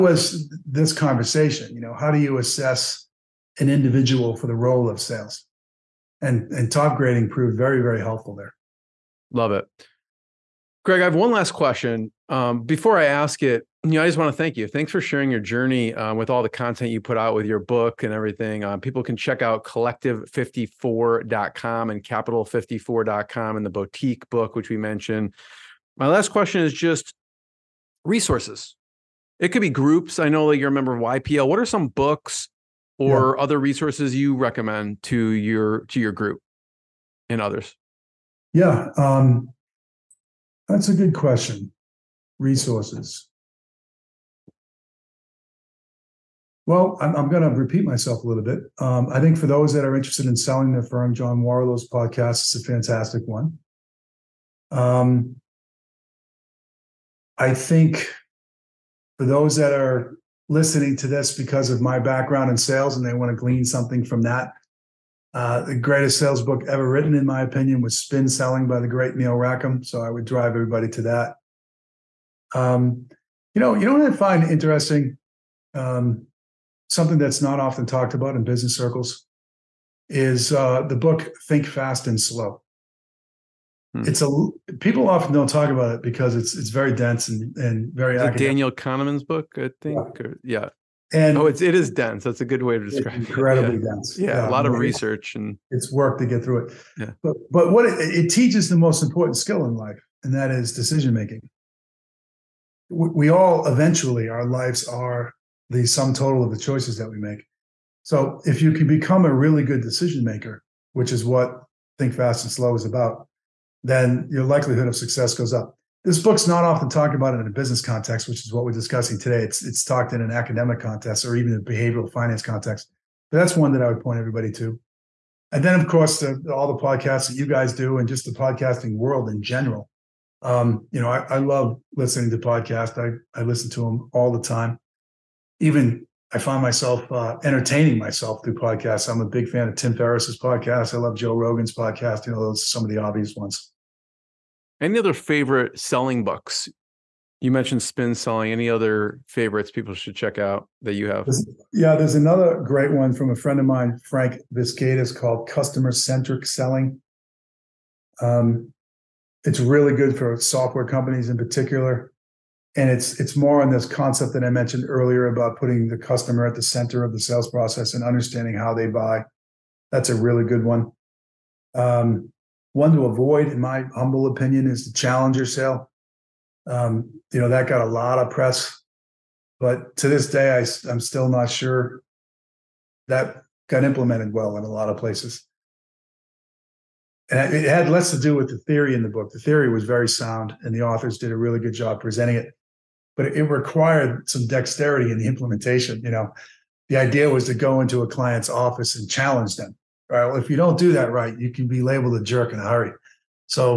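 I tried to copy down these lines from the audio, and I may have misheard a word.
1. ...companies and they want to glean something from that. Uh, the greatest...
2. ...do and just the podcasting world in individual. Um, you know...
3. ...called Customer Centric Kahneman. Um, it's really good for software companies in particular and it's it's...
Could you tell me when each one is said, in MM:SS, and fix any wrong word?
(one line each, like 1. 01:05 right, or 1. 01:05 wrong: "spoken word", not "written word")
1. 01:02 wrong: "sales", not "companies"
2. 02:07 wrong: "general", not "individual"
3. 02:35 wrong: "Selling", not "Kahneman".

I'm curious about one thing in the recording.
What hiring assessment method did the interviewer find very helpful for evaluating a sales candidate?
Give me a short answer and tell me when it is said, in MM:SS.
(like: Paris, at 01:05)
Topgrading, at 00:06.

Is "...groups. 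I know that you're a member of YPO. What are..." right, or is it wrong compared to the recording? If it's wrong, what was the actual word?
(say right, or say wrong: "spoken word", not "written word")
right.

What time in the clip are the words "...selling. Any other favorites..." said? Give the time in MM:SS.
02:28.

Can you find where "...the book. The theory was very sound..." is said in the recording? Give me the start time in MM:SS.
03:09.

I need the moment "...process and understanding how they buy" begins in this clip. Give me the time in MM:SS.
02:47.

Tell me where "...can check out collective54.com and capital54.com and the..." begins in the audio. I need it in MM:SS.
00:19.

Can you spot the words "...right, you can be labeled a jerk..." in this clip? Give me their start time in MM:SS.
03:21.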